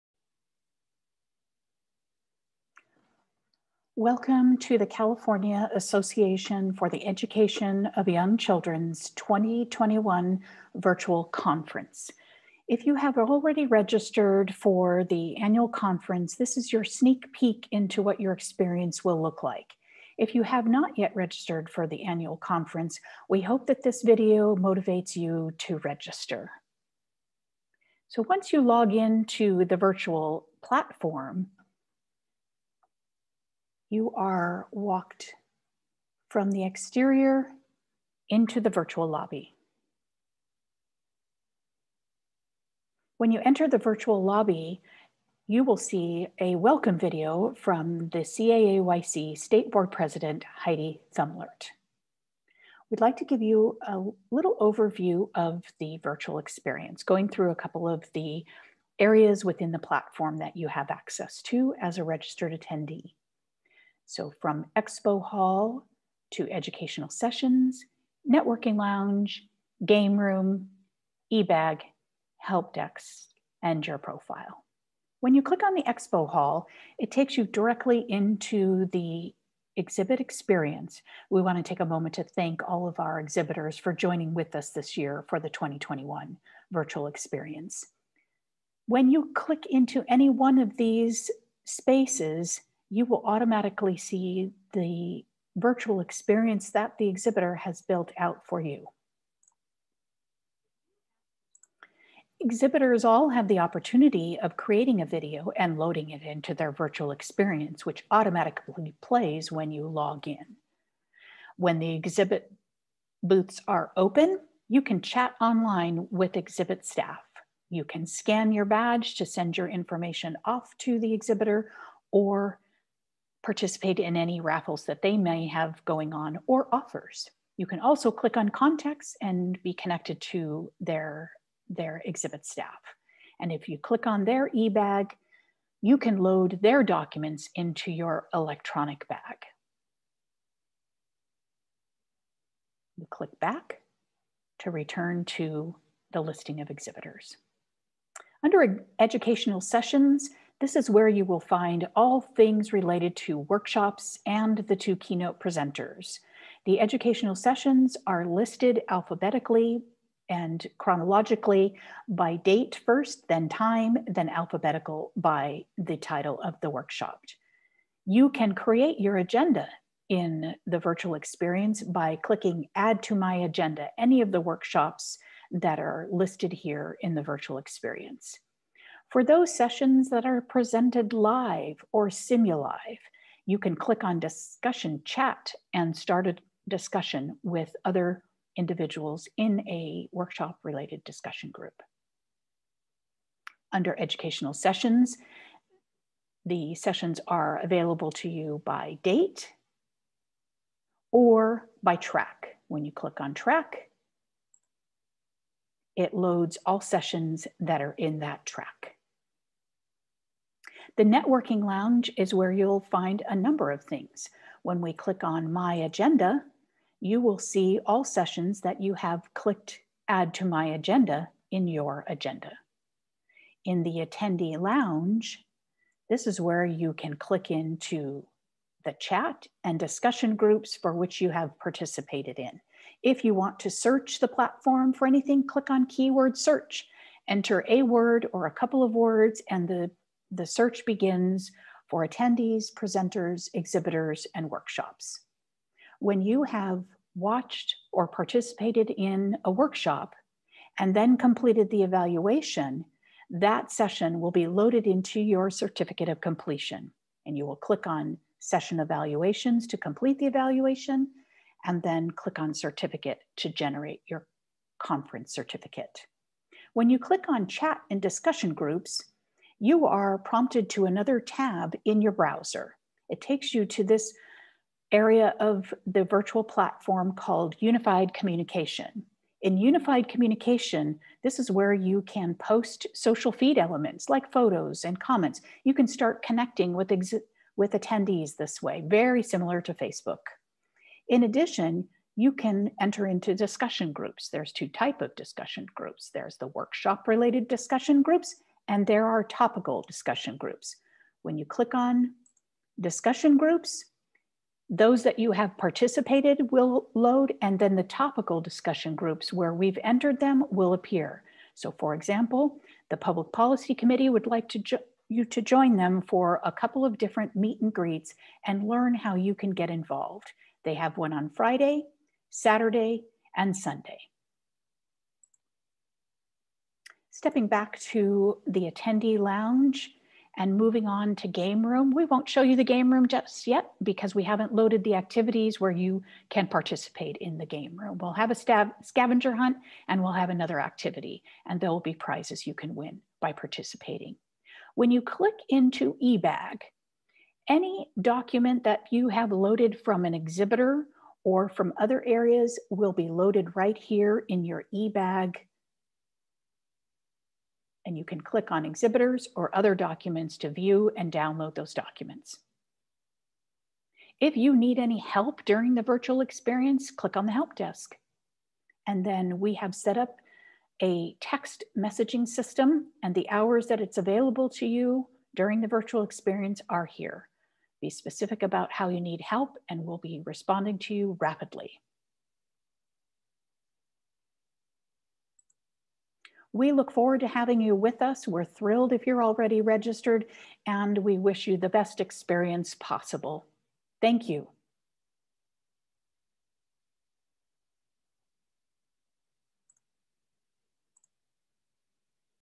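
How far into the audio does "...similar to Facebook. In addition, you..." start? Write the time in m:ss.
4:49.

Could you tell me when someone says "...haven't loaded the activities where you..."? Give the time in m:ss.
5:34.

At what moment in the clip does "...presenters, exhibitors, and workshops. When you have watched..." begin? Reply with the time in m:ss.
4:02.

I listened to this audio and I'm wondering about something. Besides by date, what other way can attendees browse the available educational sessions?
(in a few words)
By track.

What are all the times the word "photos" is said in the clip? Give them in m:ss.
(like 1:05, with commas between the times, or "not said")
4:44.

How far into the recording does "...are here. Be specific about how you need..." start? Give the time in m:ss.
6:16.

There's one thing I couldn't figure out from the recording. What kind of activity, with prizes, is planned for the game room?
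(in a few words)
Scavenger hunt.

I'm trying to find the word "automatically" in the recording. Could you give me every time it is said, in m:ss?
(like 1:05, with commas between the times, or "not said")
1:33, 1:48.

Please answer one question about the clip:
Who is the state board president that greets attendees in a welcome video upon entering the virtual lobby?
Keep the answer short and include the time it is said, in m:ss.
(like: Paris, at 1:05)
Heidi Thumlert, at 0:50.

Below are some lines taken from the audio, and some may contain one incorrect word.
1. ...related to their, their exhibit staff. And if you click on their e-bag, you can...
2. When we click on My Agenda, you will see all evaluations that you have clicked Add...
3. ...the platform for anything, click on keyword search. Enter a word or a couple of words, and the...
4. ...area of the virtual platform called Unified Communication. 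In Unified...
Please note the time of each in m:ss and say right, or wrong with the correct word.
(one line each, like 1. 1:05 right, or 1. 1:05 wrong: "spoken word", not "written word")
1. 2:09 wrong: "connected", not "related"
2. 3:34 wrong: "sessions", not "evaluations"
3. 3:54 right
4. 4:34 right.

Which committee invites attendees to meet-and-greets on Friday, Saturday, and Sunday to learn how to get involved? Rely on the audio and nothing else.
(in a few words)
Public Policy Committee.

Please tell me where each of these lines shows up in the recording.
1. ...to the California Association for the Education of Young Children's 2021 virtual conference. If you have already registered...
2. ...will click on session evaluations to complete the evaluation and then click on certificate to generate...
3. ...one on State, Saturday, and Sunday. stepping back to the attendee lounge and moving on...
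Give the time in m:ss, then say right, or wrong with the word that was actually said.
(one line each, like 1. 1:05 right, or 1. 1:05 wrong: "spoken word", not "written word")
1. 0:04 right
2. 4:17 right
3. 5:20 wrong: "Friday", not "State".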